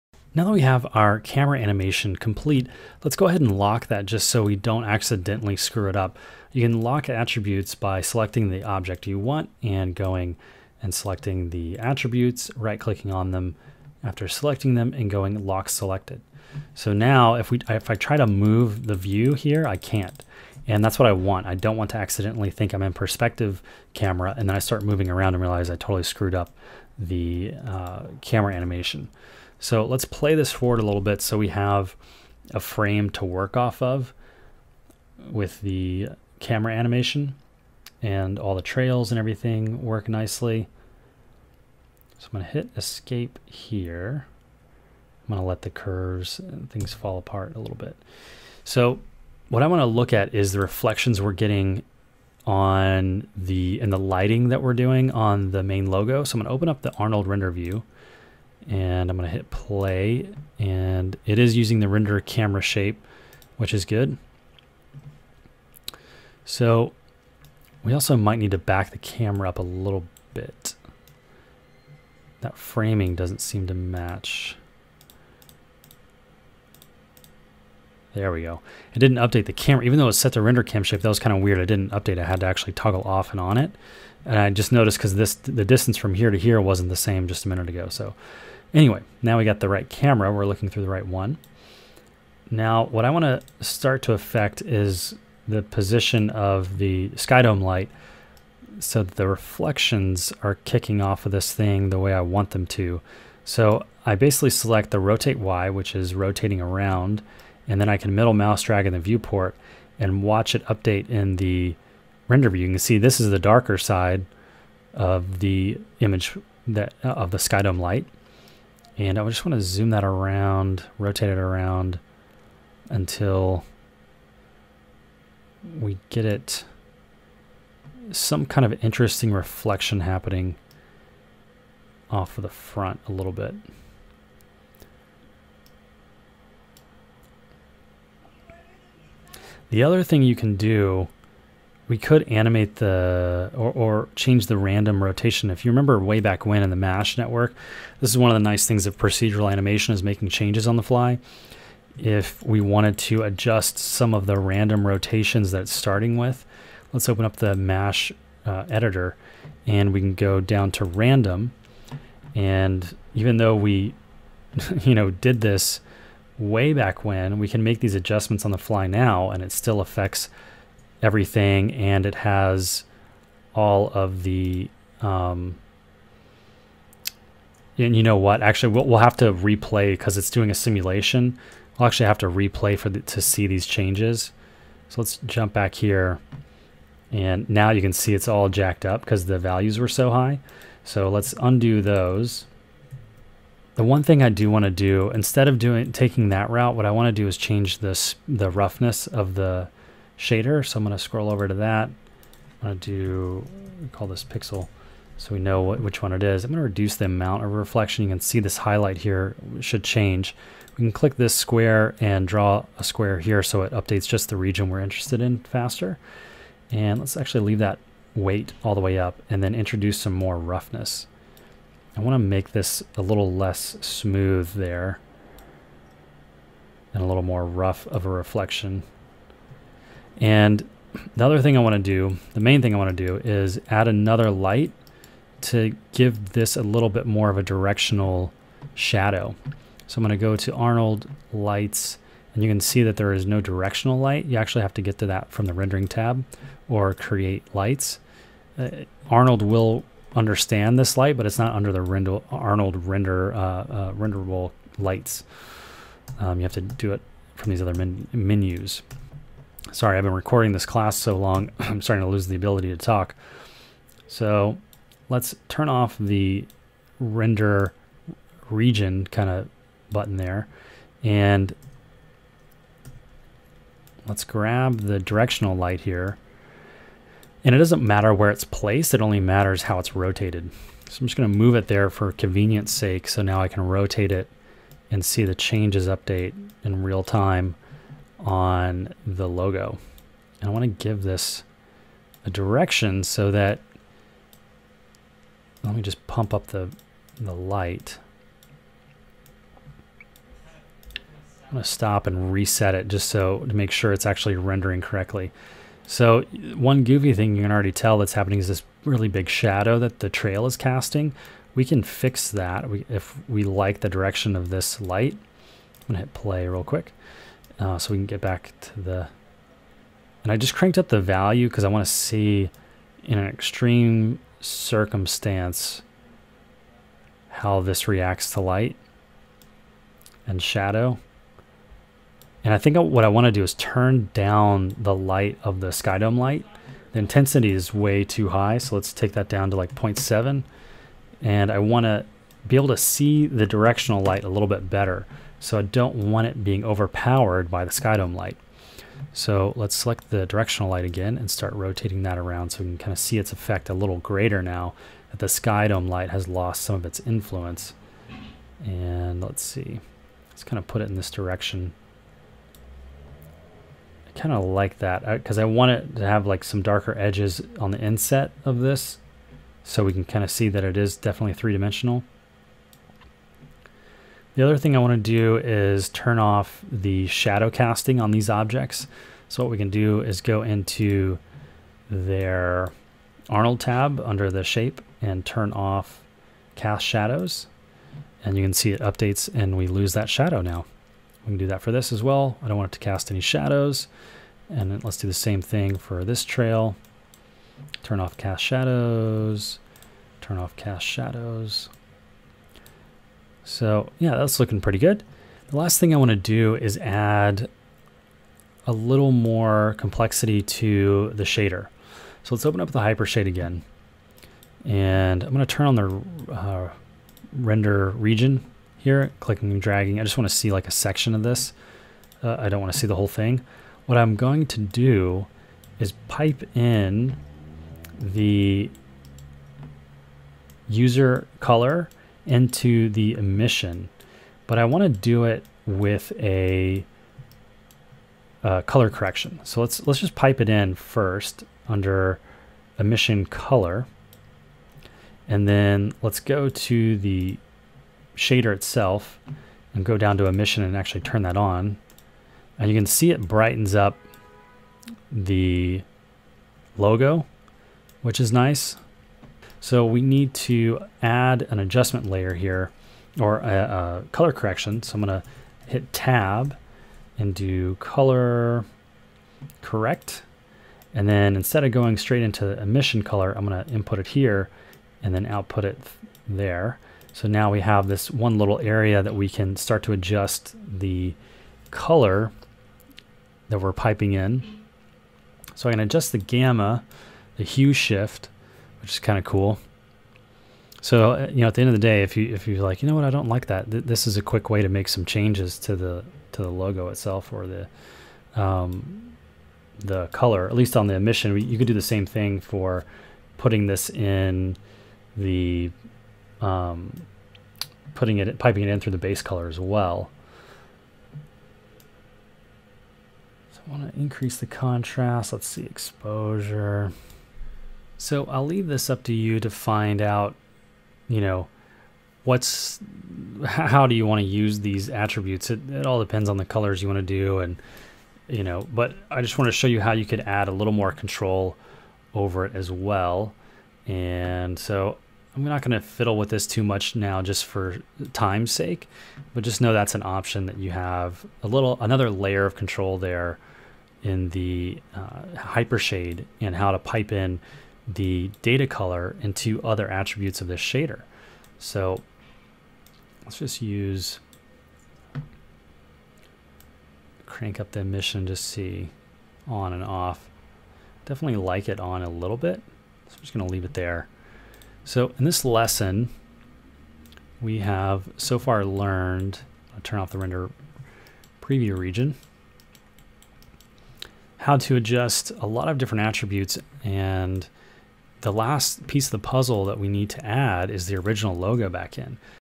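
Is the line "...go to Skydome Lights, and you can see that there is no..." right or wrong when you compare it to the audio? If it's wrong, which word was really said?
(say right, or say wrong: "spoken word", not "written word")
wrong: "Arnold", not "Skydome".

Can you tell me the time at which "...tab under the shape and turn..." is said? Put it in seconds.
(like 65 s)
383 s.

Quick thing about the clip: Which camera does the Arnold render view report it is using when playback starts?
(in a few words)
render camera shape.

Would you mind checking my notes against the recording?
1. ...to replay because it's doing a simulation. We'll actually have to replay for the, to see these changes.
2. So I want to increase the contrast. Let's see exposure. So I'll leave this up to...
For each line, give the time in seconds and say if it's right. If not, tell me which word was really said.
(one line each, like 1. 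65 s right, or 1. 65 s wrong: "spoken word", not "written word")
1. 179 s right
2. 513 s right.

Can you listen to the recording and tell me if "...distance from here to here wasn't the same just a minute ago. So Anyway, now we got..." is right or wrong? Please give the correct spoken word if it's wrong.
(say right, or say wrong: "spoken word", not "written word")
right.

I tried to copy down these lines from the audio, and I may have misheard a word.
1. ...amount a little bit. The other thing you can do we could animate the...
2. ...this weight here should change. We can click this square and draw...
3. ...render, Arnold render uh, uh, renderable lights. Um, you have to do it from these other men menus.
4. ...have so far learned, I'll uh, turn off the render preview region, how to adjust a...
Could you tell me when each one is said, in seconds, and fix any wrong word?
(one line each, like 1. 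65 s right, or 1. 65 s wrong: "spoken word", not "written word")
1. 132 s wrong: "front", not "amount"
2. 208 s wrong: "highlight", not "weight"
3. 251 s right
4. 567 s right.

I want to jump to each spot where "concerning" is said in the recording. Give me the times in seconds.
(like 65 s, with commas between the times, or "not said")
not said.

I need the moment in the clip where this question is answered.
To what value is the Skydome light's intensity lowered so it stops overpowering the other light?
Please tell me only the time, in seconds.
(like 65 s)
339 s.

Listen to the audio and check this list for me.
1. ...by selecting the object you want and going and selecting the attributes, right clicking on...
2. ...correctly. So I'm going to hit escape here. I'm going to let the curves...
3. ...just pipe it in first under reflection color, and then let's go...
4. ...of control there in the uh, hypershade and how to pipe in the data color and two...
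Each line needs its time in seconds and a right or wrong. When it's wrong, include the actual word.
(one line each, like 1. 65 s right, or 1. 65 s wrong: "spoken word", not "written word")
1. 7 s right
2. 40 s wrong: "nicely", not "correctly"
3. 439 s wrong: "emission", not "reflection"
4. 542 s right.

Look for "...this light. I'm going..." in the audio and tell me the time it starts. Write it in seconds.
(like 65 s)
314 s.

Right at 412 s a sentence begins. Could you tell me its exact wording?
So let's open up the Hypershade again.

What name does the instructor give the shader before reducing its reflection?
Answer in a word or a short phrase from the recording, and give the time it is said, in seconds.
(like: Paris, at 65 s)
pixel, at 204 s.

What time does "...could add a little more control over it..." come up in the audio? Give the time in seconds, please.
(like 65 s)
530 s.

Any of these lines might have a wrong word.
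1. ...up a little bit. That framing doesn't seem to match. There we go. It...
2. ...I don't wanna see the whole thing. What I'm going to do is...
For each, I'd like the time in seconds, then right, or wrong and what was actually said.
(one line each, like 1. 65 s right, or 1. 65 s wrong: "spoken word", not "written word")
1. 69 s right
2. 422 s right.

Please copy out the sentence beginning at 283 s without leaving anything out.
So now I can rotate it and see the changes update in real time on the logo.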